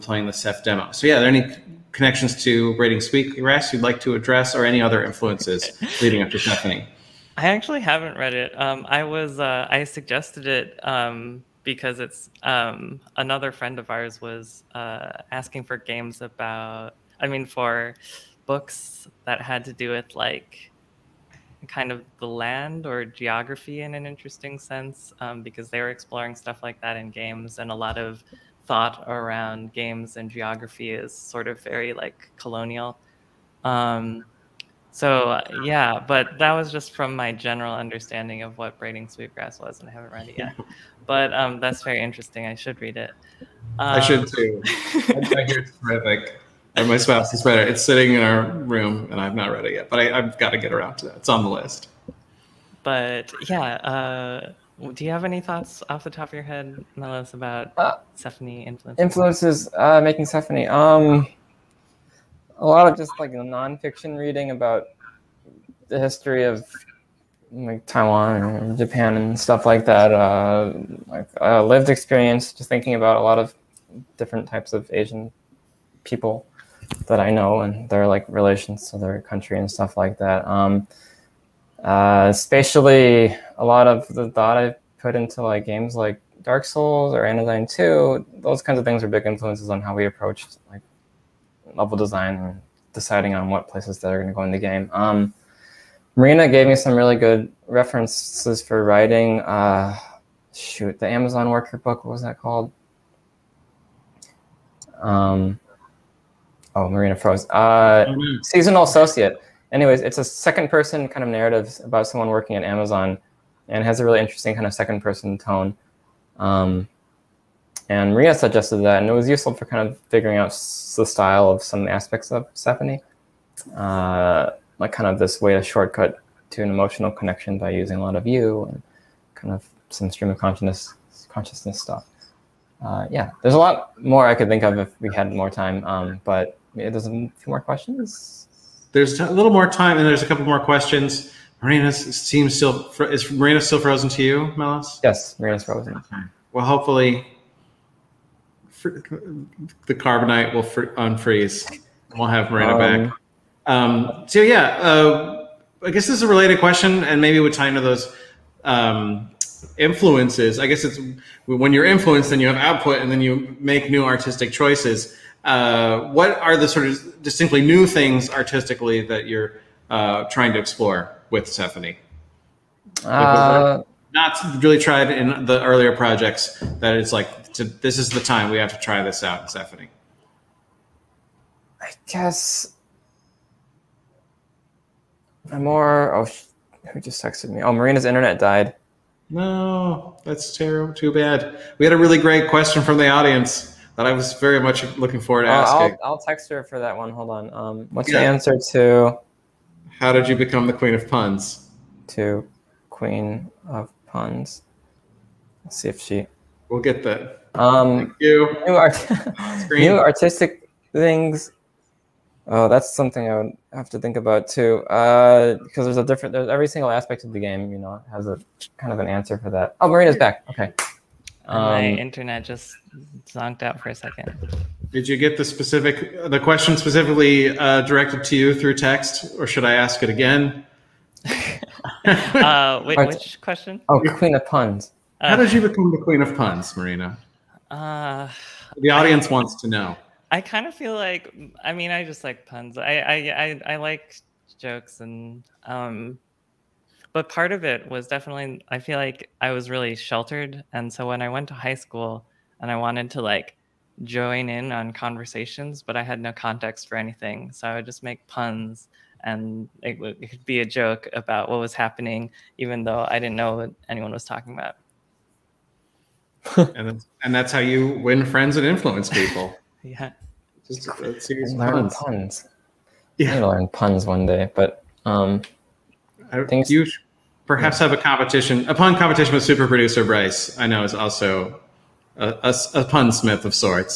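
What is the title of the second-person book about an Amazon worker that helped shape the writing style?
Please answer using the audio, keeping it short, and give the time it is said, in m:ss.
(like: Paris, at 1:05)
Seasonal Associate, at 1:48.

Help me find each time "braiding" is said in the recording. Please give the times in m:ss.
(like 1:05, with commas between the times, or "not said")
0:02, 0:38.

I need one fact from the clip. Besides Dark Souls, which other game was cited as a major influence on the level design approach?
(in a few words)
Anodyne 2.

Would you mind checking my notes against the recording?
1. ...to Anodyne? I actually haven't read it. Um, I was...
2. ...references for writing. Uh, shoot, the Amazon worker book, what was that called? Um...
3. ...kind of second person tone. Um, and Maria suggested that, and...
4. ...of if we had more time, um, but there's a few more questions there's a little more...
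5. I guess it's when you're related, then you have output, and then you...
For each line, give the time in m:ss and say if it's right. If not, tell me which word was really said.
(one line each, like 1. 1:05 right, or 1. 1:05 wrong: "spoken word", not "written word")
1. 0:06 wrong: "Sephonie", not "Anodyne"
2. 1:37 right
3. 1:54 right
4. 2:14 right
5. 2:40 wrong: "influenced", not "related".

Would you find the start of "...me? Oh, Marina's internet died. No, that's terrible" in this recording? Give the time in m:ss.
3:07.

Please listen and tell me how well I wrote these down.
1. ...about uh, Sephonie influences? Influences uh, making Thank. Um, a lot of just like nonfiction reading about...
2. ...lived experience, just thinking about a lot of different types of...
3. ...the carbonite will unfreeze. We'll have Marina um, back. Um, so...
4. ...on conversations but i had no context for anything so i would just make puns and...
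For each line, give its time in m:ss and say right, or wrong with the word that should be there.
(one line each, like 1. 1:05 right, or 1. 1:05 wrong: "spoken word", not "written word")
1. 0:57 wrong: "Sephonie", not "Thank"
2. 1:11 right
3. 2:28 right
4. 4:14 right.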